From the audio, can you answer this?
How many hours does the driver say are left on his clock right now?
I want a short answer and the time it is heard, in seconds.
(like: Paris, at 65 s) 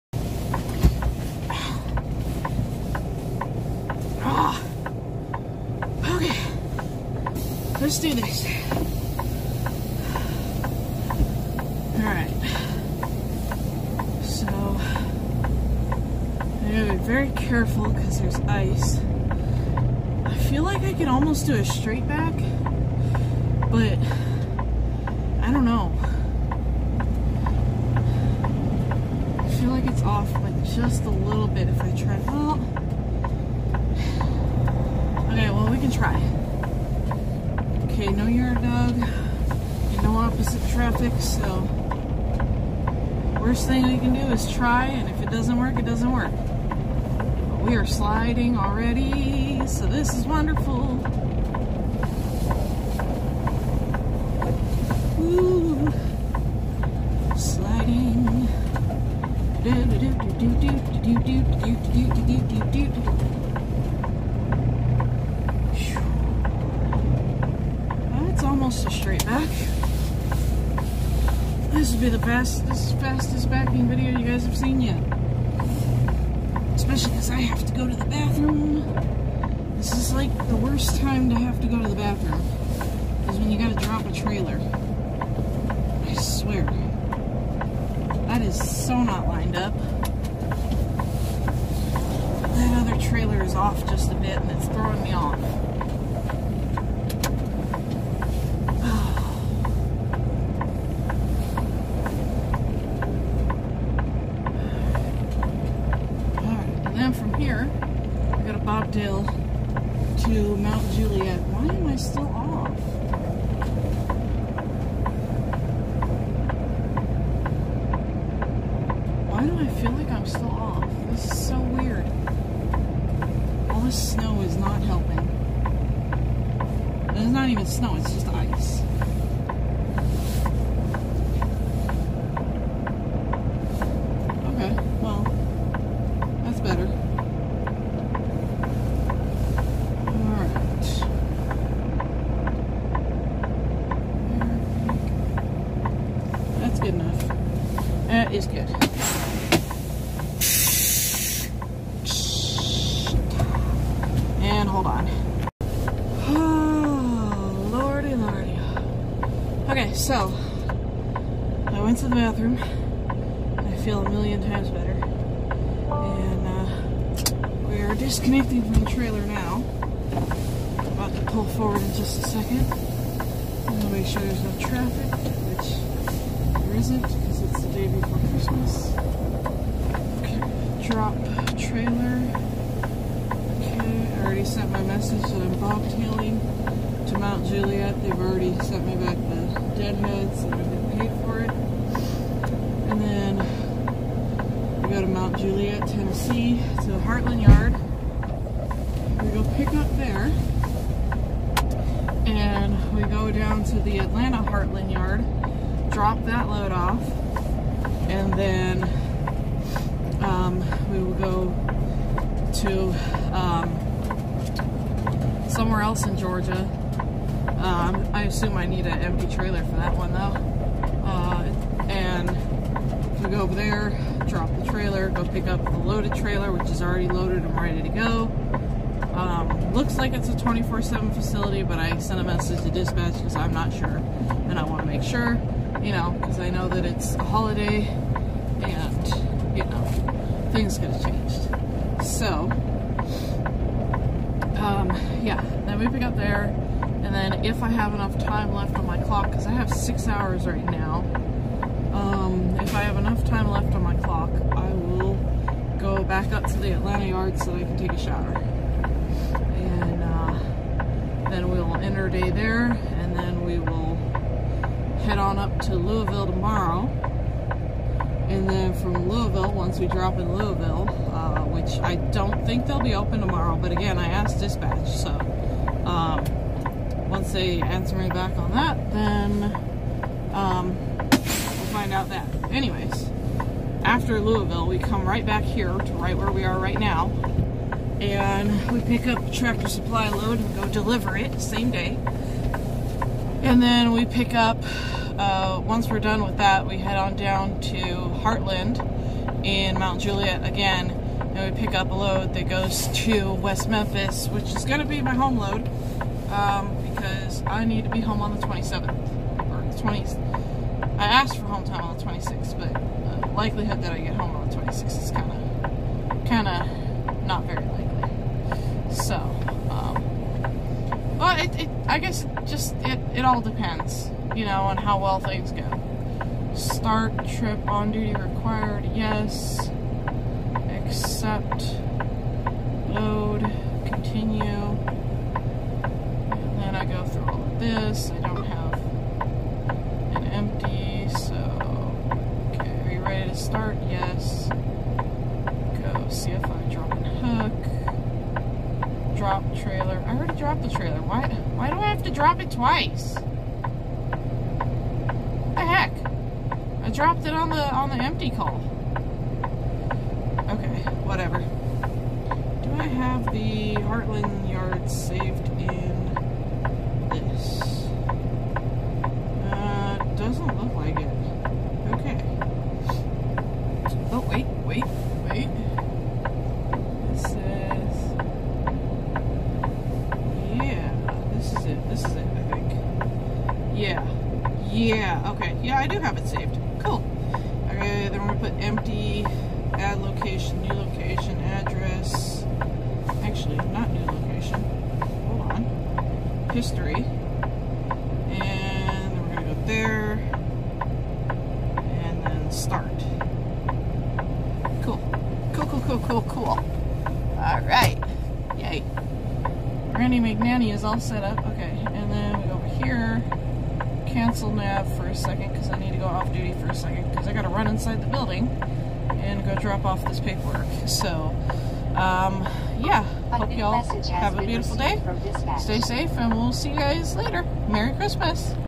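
6, at 249 s.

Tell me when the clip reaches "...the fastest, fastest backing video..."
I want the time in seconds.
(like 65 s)
72 s.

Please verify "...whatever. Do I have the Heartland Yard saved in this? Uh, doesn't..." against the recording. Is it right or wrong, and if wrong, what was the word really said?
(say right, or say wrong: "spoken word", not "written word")
right.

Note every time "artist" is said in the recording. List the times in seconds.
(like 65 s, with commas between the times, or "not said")
not said.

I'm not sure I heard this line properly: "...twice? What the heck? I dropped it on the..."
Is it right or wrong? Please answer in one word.
right.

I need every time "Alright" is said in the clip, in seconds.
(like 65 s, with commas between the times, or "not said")
11 s, 407 s.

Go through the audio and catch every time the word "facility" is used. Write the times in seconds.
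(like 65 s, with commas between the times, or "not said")
231 s.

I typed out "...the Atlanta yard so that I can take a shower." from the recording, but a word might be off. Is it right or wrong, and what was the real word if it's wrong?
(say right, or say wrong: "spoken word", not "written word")
right.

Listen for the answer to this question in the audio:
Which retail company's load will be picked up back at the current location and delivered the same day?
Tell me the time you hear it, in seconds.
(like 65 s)
289 s.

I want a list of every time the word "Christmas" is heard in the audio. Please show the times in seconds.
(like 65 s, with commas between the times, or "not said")
178 s, 427 s.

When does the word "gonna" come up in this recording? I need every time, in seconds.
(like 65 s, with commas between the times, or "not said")
388 s, 399 s.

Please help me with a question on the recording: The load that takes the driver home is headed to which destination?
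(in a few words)
West Memphis.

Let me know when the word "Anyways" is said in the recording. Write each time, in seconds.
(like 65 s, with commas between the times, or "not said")
282 s.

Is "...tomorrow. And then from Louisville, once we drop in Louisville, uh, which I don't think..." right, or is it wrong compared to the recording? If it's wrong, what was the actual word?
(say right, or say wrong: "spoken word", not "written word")
right.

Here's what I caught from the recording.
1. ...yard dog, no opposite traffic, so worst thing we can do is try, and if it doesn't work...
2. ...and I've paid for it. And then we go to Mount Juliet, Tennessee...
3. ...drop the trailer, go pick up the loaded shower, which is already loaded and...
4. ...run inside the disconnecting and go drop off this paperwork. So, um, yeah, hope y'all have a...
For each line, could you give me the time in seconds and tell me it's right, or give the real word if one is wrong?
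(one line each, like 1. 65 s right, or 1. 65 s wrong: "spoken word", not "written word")
1. 38 s right
2. 190 s right
3. 224 s wrong: "trailer", not "shower"
4. 417 s wrong: "building", not "disconnecting".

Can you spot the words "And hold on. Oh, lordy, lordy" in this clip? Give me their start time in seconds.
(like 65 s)
154 s.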